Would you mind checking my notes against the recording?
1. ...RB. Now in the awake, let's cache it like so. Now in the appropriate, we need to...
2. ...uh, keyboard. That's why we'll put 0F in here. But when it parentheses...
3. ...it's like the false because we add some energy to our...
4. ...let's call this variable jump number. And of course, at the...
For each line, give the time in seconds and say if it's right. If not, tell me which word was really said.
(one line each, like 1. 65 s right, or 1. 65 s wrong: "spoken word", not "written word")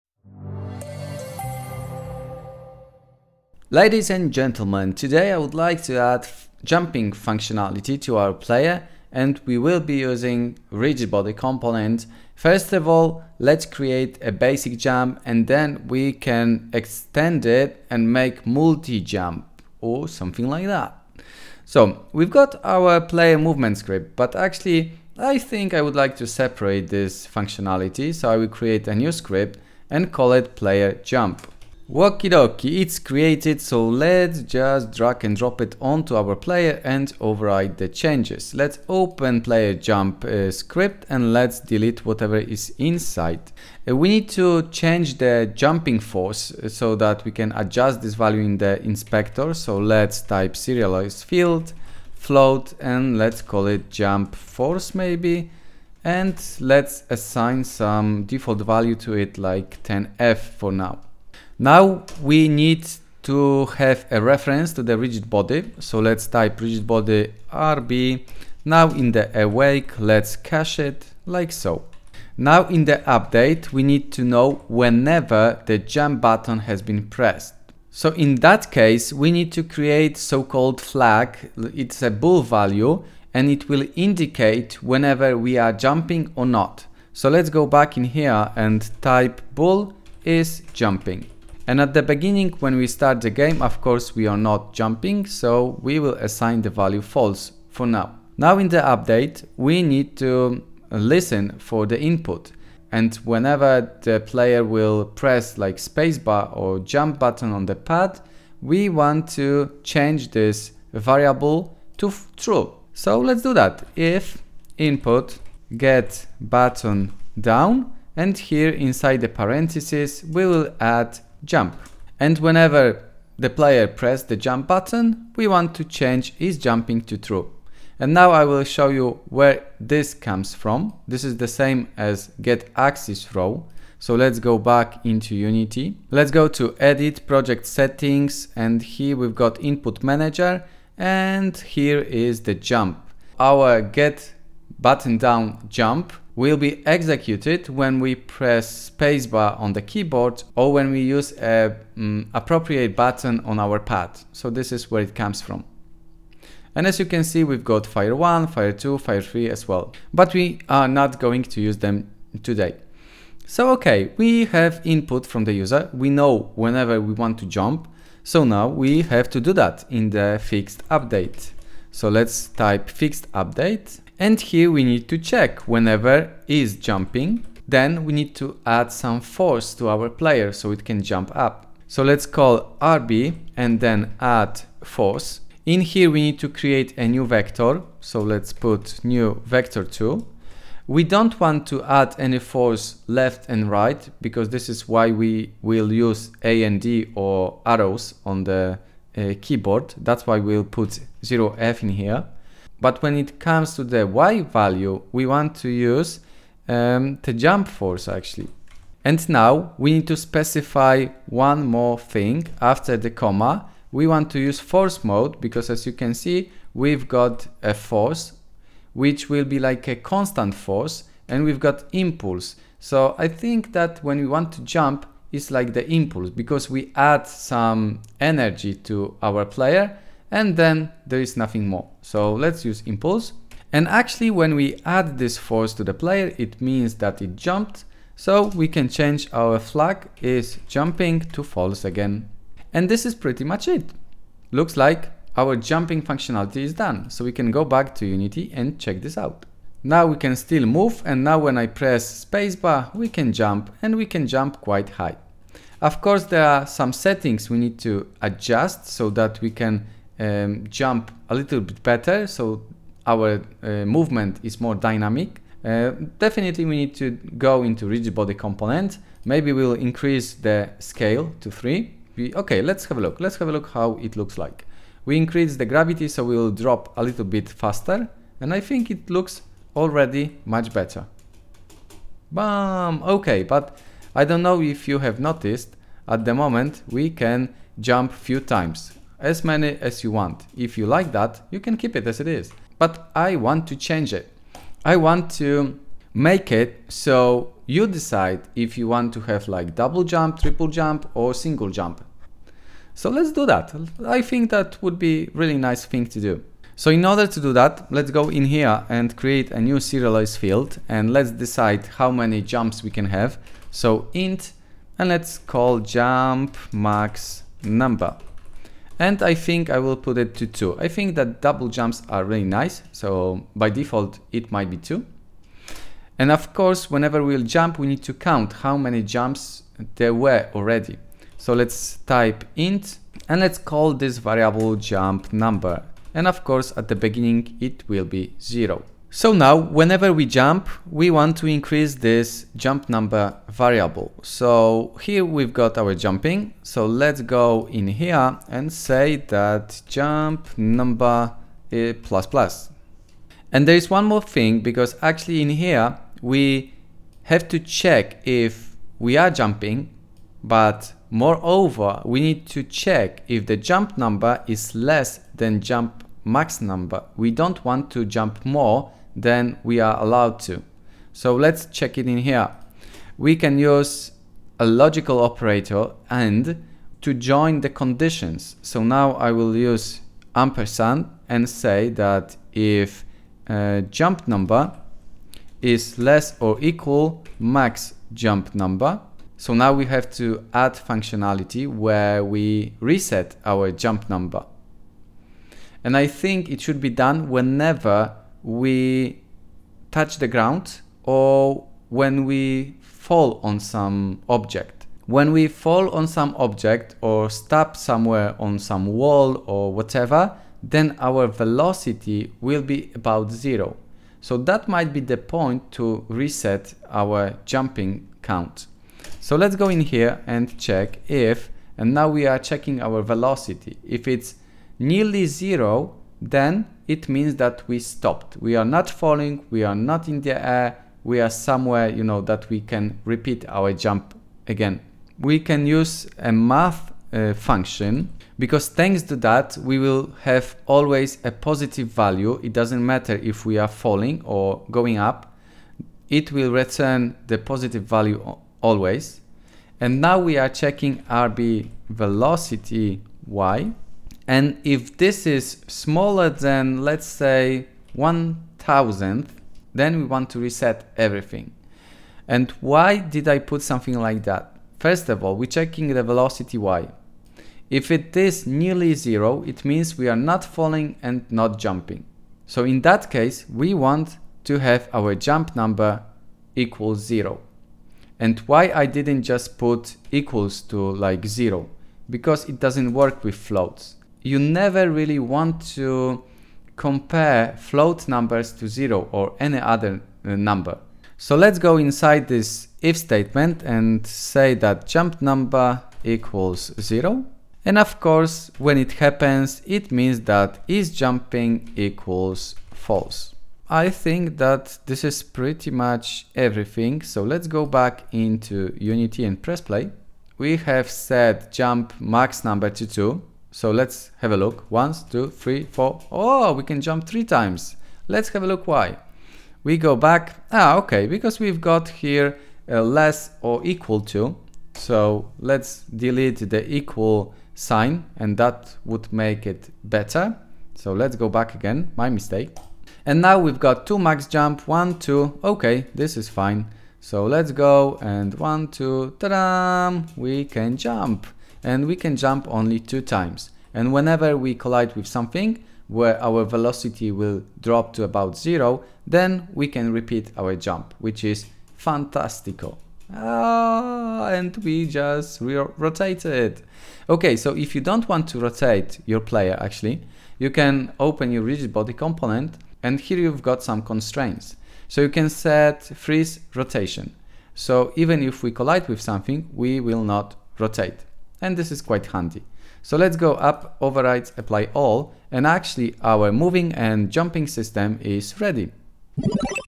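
1. 67 s wrong: "update", not "appropriate"
2. 199 s wrong: "comes", not "parentheses"
3. 225 s wrong: "impulse", not "false"
4. 333 s right.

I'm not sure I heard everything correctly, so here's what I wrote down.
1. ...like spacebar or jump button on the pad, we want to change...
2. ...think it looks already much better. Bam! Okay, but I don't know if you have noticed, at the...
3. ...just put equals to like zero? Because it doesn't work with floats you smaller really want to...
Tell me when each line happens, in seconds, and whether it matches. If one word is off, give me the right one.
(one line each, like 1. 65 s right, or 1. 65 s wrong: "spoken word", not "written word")
1. 105 s right
2. 278 s right
3. 479 s wrong: "never", not "smaller".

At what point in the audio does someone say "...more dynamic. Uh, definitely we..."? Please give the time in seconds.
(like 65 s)
264 s.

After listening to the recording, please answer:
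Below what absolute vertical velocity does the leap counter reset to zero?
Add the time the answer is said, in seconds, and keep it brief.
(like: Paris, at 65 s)
1000th, at 457 s.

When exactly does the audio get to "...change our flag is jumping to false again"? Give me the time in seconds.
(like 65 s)
238 s.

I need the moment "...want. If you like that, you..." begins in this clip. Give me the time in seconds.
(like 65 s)
290 s.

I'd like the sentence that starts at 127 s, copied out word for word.
And now I will show you where this comes from.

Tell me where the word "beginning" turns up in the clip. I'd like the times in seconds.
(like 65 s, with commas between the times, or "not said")
92 s, 336 s.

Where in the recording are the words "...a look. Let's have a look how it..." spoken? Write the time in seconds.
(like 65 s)
272 s.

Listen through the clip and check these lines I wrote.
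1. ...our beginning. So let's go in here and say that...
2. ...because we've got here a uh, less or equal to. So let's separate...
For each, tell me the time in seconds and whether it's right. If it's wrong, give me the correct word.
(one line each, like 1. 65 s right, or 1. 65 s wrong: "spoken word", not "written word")
1. 345 s wrong: "jumping", not "beginning"
2. 521 s wrong: "delete", not "separate".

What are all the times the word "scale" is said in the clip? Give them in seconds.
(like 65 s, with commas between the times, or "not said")
270 s.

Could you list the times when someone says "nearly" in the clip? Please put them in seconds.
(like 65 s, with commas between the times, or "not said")
424 s, 468 s.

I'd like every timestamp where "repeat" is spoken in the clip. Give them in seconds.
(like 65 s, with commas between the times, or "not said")
433 s, 549 s.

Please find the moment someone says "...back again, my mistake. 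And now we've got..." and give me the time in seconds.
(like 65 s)
531 s.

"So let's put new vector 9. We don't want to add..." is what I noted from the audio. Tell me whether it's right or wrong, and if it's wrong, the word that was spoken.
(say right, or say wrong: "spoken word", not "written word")
wrong: "2", not "9".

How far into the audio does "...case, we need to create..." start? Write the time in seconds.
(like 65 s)
78 s.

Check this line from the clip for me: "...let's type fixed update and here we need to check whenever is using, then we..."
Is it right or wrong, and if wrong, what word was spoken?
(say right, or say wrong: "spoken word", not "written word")
wrong: "jumping", not "using".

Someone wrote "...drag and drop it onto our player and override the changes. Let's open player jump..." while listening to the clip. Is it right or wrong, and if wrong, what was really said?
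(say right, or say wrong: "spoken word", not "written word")
right.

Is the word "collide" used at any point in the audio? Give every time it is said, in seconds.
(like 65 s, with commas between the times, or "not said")
544 s, 568 s.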